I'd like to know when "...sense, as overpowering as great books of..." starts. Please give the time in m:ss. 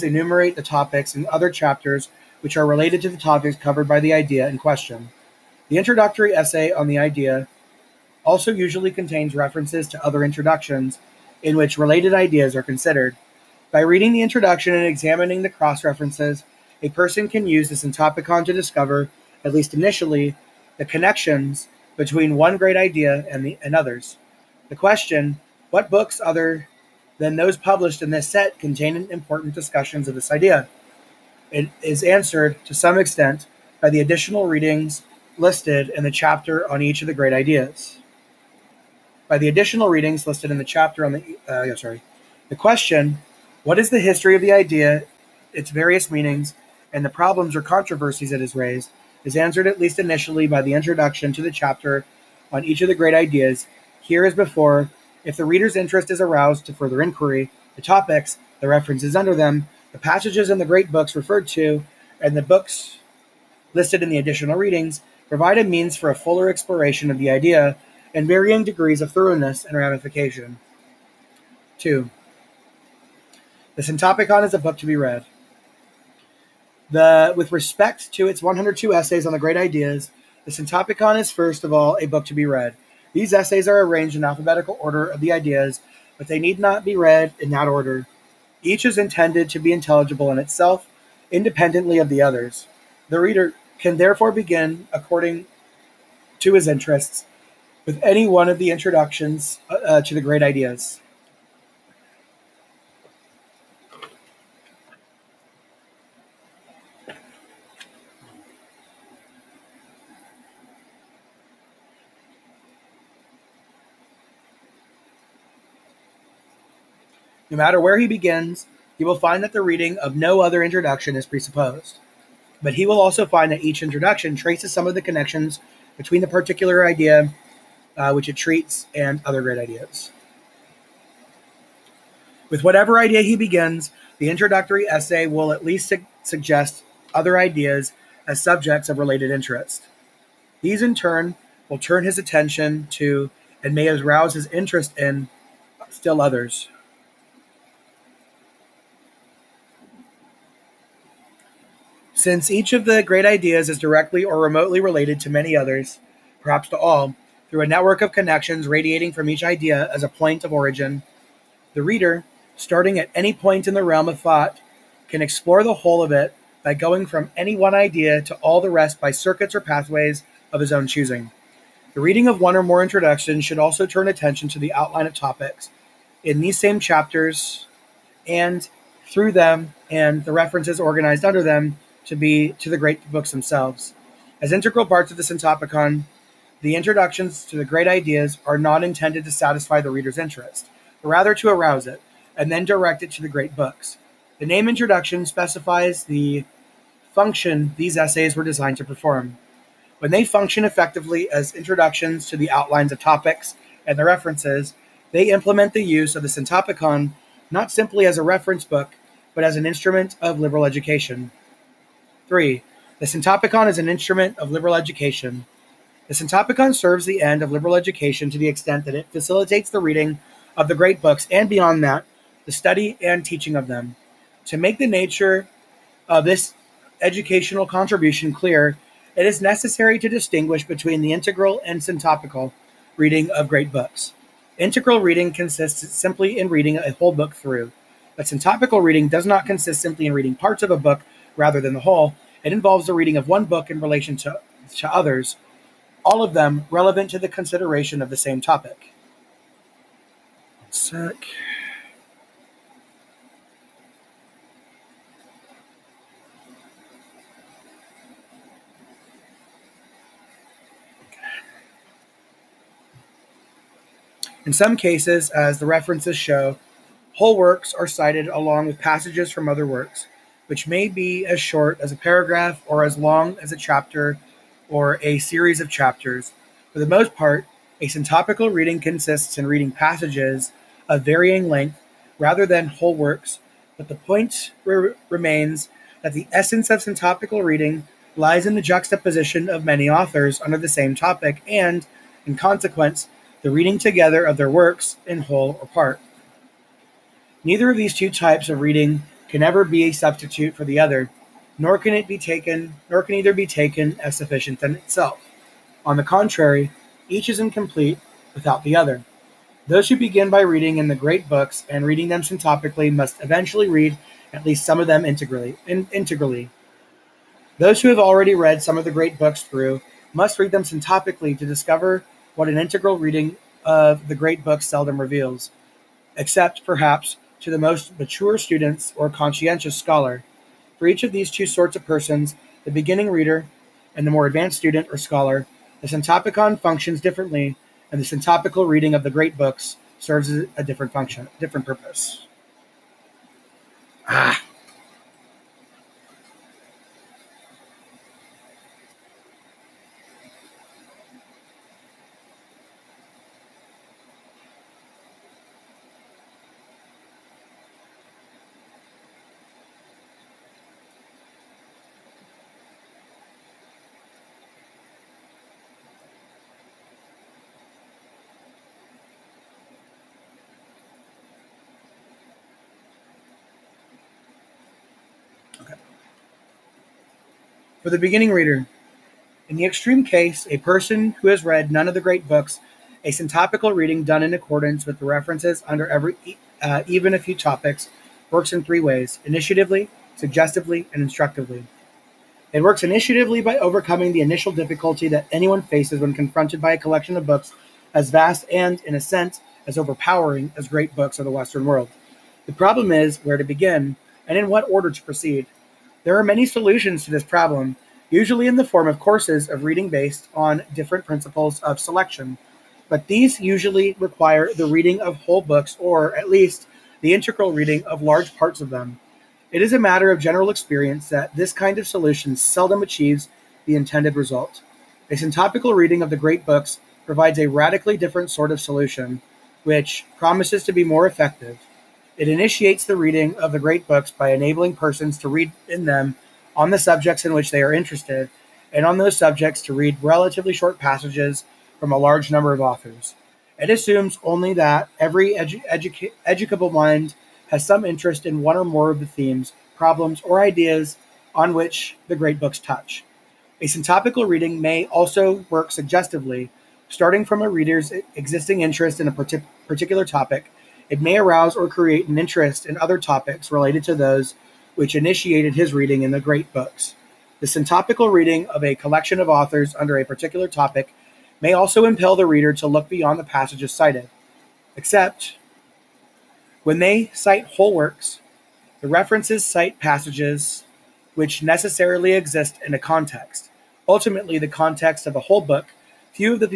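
6:39.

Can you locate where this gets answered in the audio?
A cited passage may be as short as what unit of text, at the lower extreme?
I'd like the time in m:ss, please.
4:31.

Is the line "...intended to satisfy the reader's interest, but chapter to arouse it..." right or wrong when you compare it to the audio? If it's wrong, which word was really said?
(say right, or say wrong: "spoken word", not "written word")
wrong: "rather", not "chapter".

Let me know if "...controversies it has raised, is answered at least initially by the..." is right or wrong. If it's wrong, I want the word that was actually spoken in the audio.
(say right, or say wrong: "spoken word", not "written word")
right.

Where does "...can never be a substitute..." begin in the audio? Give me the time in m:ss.
4:59.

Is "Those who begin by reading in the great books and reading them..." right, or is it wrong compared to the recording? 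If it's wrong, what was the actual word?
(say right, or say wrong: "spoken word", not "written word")
right.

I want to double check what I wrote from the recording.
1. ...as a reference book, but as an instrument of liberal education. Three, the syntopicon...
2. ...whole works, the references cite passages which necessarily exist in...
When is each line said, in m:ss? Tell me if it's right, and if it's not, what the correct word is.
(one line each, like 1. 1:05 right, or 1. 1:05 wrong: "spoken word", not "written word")
1. 3:28 right
2. 7:57 right.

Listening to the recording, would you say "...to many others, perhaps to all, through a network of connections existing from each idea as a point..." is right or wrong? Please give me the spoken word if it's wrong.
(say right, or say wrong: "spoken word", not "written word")
wrong: "radiating", not "existing".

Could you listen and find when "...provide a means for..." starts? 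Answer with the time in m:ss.
1:05.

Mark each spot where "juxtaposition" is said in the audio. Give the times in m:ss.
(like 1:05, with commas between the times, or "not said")
4:48.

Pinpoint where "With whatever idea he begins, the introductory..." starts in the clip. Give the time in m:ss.
2:12.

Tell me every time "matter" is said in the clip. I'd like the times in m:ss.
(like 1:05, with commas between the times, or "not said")
1:57, 6:59.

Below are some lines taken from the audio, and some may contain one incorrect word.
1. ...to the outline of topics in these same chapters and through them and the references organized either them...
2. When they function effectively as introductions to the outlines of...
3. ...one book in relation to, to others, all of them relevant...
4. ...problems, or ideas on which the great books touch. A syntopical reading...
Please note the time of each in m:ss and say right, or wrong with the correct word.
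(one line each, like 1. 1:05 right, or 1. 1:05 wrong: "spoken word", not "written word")
1. 2:54 wrong: "under", not "either"
2. 3:19 right
3. 4:03 right
4. 7:29 right.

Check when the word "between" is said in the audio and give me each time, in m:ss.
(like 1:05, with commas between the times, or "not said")
0:21, 2:05, 3:50.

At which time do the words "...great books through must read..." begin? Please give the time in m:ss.
5:18.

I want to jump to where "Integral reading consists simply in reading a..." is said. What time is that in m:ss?
3:54.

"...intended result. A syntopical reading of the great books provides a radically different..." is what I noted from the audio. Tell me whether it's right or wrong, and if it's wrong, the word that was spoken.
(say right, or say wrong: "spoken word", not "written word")
right.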